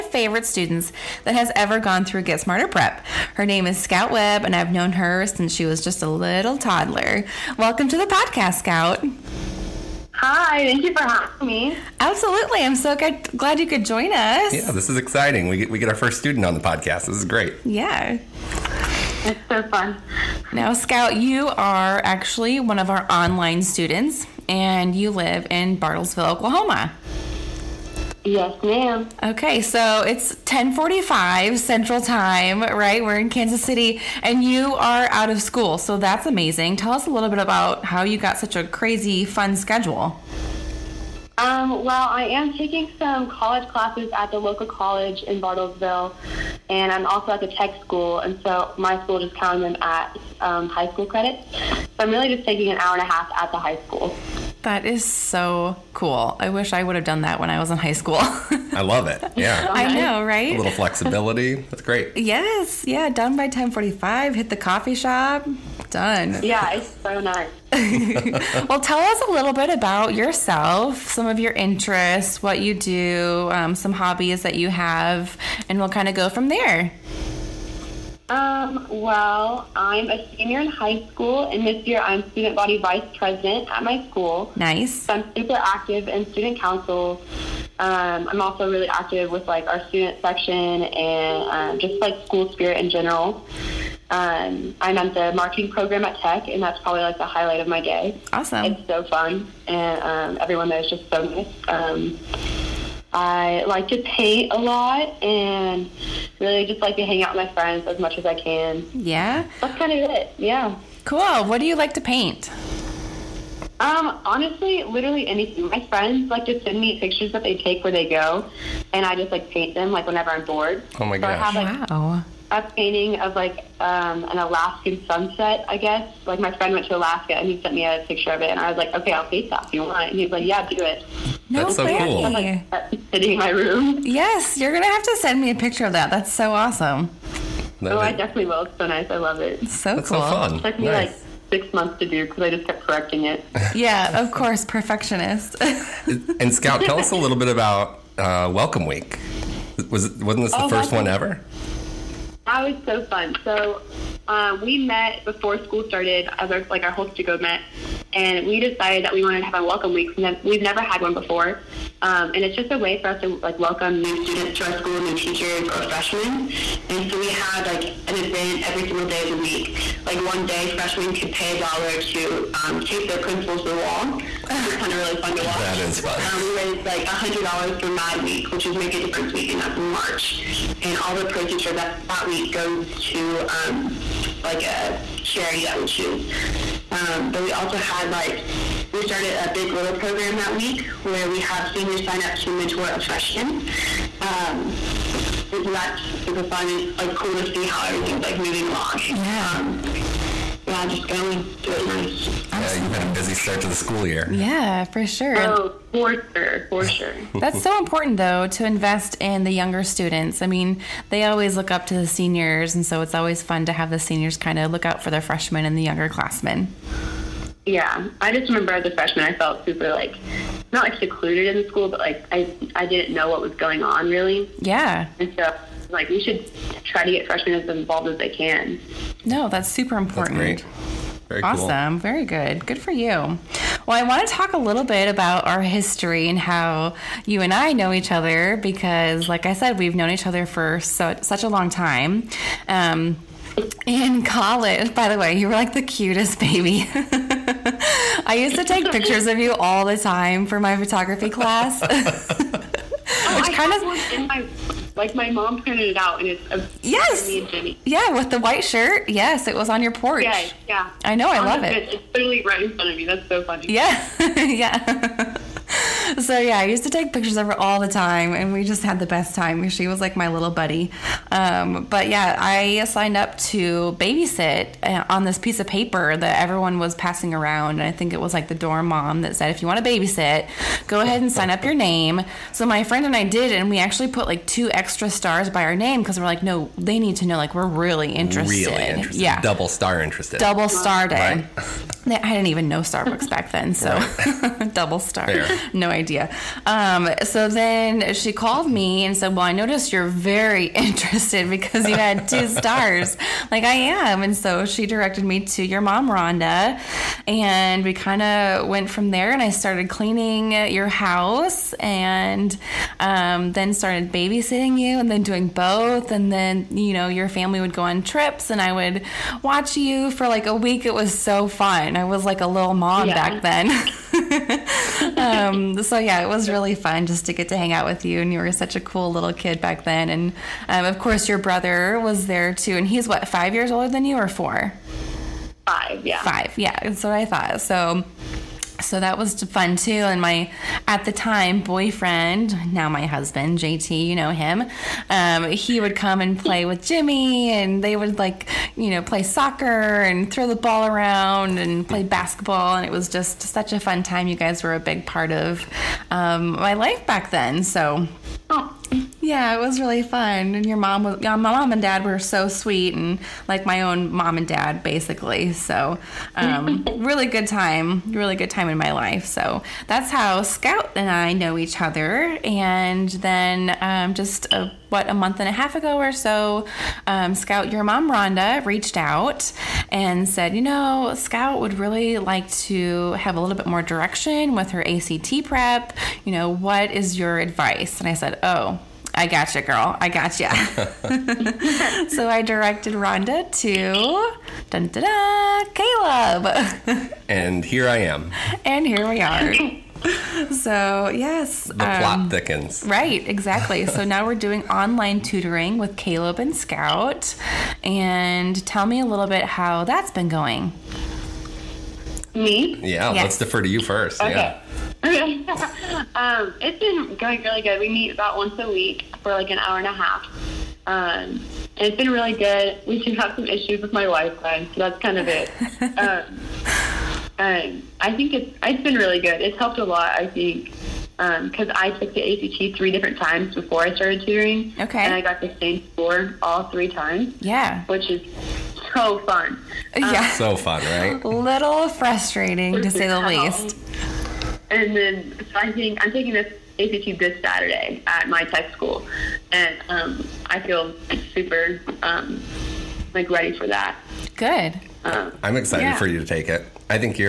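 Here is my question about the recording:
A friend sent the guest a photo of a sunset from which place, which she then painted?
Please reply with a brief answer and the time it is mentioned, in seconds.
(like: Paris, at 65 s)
Alaska, at 124 s.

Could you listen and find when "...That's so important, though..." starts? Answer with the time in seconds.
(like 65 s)
207 s.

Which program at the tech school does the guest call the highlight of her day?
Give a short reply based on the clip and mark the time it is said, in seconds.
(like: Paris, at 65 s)
Marketing, at 95 s.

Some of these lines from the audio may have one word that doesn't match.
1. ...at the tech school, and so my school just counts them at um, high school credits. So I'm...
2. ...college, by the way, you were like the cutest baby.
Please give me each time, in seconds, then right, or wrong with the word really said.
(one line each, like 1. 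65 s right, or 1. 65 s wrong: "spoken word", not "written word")
1. 47 s right
2. 244 s right.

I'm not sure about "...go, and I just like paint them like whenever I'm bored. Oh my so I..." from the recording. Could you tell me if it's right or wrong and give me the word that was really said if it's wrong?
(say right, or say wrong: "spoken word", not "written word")
right.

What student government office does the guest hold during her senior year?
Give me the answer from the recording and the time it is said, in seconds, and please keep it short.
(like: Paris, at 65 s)
Student body vice president, at 82 s.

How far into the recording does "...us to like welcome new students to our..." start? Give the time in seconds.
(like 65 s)
163 s.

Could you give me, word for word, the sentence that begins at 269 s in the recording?
She was like my little buddy.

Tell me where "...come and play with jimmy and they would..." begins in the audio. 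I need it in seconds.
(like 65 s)
345 s.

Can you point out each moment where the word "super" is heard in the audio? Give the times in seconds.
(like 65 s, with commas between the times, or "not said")
85 s, 196 s, 219 s, 229 s, 451 s.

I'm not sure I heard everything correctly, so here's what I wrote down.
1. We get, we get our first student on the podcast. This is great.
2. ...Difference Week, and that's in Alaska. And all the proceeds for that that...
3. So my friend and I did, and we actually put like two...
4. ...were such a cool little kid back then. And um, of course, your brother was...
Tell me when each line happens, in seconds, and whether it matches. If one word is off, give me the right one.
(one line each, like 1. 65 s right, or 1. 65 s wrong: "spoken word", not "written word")
1. 15 s right
2. 178 s wrong: "March", not "Alaska"
3. 282 s right
4. 328 s right.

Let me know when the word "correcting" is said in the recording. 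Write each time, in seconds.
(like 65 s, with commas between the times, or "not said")
142 s.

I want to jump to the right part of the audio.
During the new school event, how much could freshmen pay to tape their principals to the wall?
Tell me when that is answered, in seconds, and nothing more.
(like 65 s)
171 s.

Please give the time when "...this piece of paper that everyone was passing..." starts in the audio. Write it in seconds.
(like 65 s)
275 s.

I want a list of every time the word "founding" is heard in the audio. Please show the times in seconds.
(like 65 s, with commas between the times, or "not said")
not said.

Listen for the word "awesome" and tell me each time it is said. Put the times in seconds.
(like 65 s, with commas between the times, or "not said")
98 s, 136 s, 231 s.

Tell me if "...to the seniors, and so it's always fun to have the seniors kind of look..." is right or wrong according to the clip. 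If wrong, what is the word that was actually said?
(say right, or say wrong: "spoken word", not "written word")
right.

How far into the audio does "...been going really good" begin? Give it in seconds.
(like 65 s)
416 s.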